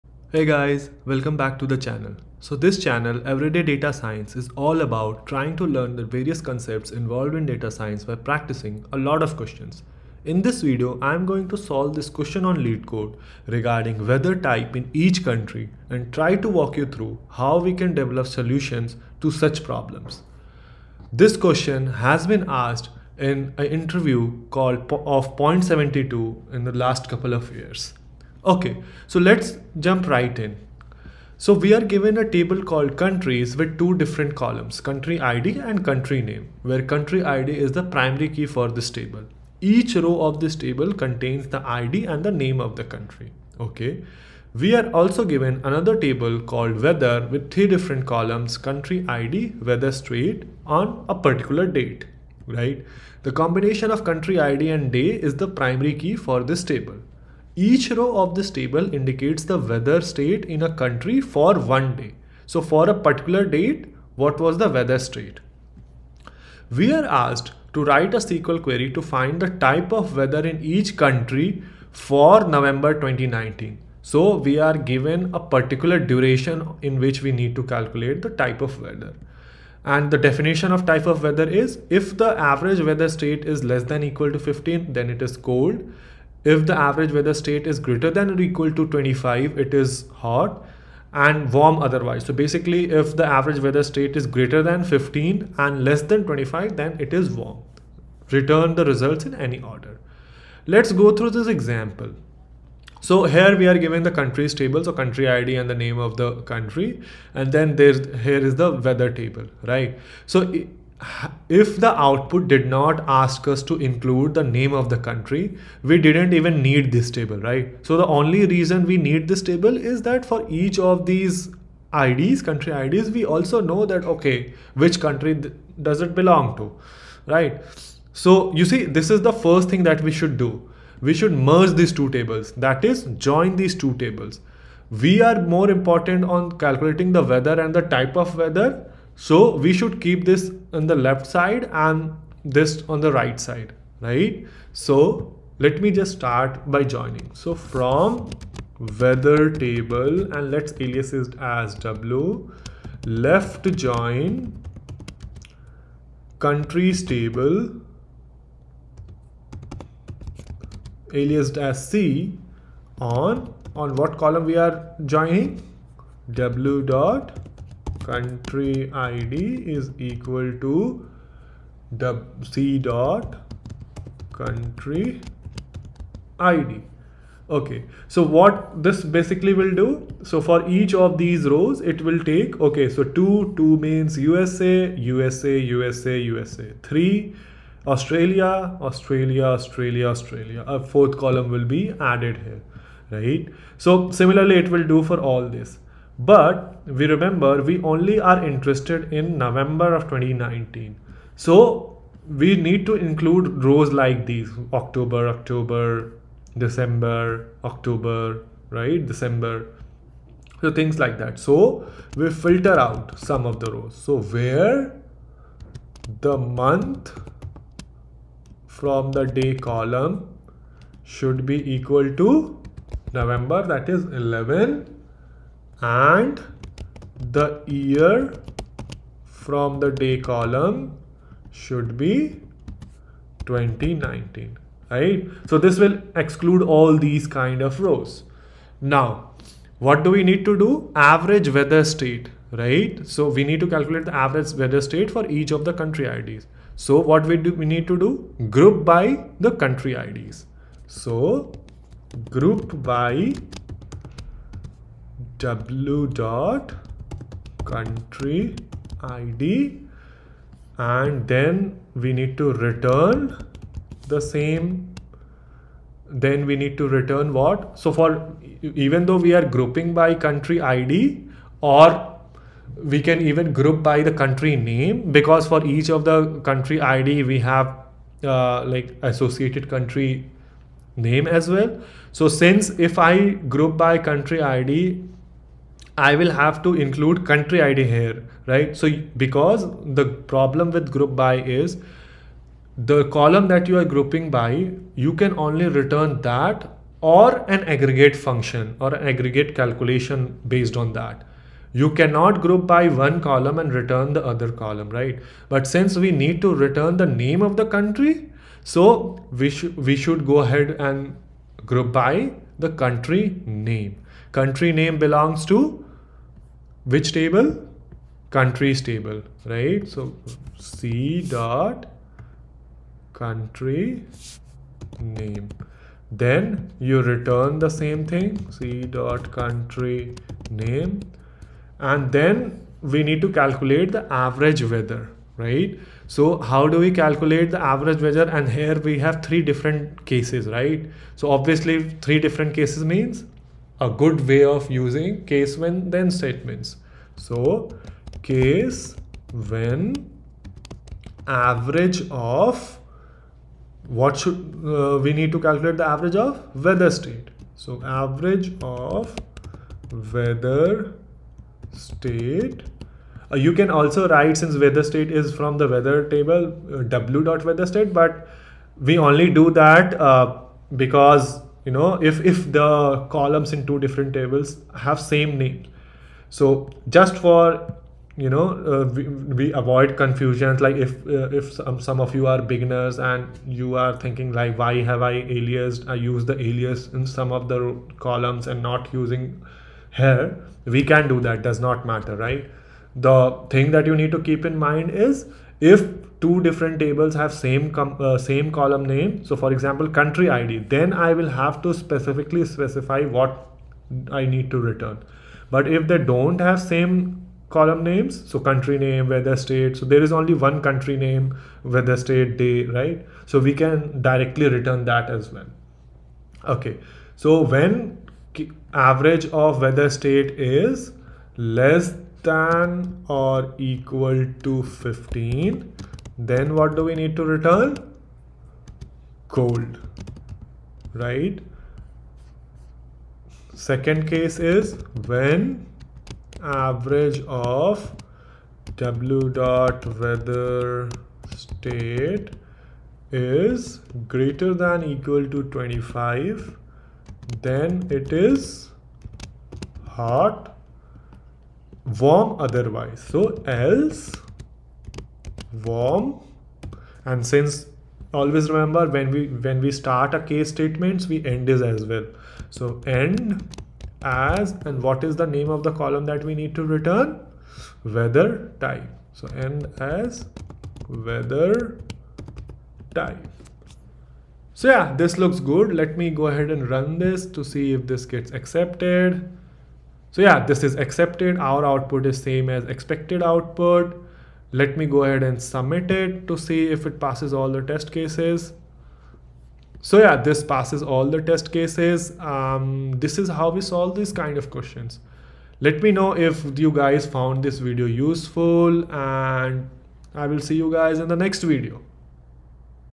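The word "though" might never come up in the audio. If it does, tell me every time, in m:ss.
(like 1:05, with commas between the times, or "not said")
4:29.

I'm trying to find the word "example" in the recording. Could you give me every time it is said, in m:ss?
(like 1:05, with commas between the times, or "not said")
1:41, 6:39.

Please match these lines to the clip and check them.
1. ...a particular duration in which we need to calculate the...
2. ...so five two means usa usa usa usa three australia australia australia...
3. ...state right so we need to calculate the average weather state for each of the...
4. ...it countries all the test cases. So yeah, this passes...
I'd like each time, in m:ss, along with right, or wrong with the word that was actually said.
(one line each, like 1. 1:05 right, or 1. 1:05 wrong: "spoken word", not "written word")
1. 1:15 right
2. 3:02 wrong: "two", not "five"
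3. 4:01 right
4. 8:06 wrong: "passes", not "countries".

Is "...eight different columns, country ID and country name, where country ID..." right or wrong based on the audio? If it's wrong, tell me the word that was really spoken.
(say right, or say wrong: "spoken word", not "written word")
wrong: "two", not "eight".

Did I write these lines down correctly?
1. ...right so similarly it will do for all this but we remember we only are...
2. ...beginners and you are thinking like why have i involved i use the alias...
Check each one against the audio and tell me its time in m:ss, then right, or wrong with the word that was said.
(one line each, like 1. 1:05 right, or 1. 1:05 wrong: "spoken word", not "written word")
1. 3:13 right
2. 6:22 wrong: "aliased", not "involved".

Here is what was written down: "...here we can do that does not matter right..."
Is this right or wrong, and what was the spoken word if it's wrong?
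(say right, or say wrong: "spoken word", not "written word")
right.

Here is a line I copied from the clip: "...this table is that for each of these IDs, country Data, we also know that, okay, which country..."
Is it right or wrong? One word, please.
wrong.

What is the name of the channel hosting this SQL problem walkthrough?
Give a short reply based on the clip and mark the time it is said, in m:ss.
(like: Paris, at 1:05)
Everyday Data Science, at 0:03.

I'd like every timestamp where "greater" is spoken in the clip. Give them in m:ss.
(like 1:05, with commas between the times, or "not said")
1:27, 1:34, 7:24.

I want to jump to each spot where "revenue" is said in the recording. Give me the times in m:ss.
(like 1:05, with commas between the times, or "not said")
not said.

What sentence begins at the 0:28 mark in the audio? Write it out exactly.
Okay, so let's jump right in.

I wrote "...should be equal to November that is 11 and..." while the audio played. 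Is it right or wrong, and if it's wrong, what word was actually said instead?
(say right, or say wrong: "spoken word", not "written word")
right.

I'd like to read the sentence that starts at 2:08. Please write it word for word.
So you see, this is the first thing that we should do.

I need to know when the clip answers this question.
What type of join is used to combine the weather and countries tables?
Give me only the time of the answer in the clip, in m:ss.
2:33.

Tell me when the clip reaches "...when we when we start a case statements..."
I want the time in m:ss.
7:38.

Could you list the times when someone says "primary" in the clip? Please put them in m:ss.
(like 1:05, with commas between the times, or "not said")
0:37, 0:55.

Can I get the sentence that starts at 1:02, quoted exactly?
So for a particular date, what was the weather state?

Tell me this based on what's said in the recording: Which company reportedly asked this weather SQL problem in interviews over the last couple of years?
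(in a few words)
Point72.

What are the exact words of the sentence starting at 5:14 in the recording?
Country name belongs to which table?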